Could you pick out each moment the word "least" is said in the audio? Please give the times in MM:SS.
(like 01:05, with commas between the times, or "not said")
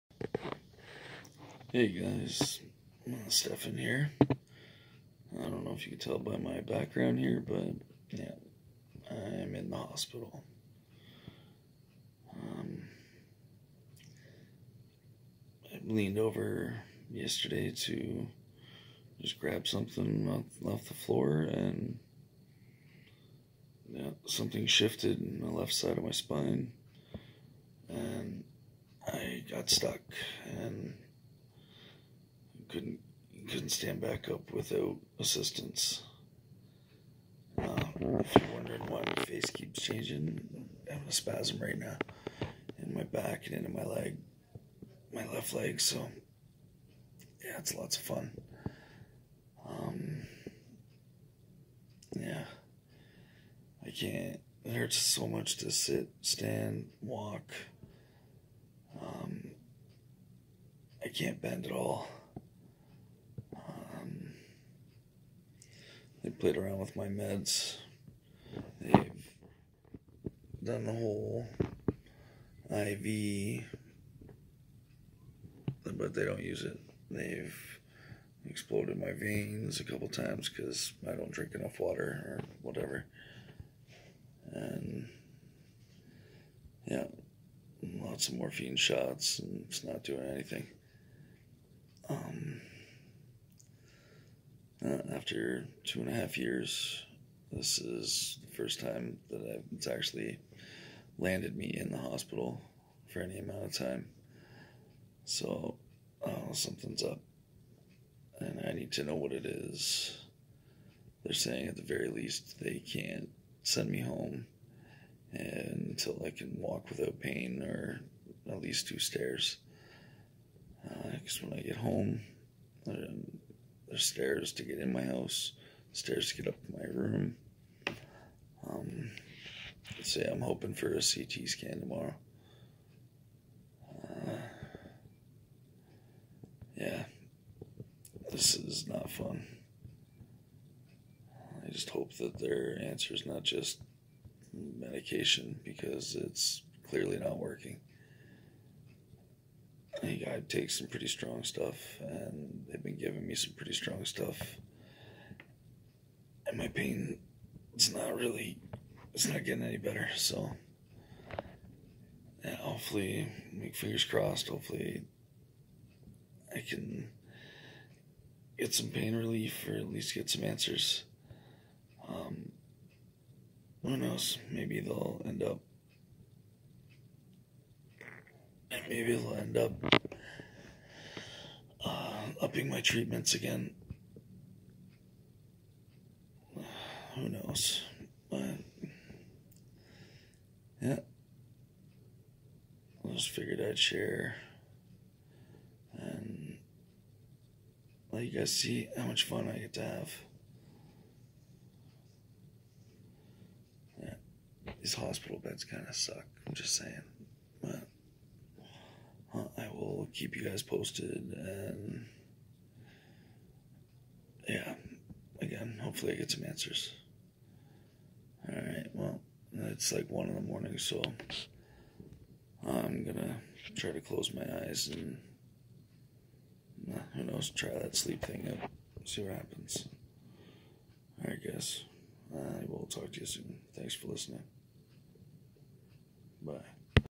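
01:52, 01:58, 02:49.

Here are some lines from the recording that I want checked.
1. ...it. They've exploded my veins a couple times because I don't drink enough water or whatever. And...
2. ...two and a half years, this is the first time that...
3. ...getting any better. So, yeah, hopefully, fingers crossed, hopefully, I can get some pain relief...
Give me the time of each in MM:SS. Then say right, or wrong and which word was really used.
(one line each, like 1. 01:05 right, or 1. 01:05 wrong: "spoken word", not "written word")
1. 01:16 right
2. 01:35 right
3. 02:39 right.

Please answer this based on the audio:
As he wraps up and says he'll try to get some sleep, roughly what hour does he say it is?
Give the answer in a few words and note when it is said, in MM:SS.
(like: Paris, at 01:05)
1 in the morning, at 03:40.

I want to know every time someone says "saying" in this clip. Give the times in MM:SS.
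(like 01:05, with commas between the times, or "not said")
01:51, 03:26.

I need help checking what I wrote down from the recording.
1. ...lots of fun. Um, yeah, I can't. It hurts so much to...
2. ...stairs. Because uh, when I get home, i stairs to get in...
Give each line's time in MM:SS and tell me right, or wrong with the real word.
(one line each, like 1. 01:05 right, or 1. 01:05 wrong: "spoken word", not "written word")
1. 00:47 right
2. 01:58 right.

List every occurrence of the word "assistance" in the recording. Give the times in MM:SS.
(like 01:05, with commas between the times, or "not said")
00:35.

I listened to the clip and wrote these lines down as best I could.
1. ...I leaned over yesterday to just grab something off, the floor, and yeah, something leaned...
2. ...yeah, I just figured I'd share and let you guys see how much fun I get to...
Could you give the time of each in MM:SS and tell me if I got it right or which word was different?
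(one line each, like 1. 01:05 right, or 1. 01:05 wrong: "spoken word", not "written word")
1. 00:15 wrong: "shifted", not "leaned"
2. 03:10 right.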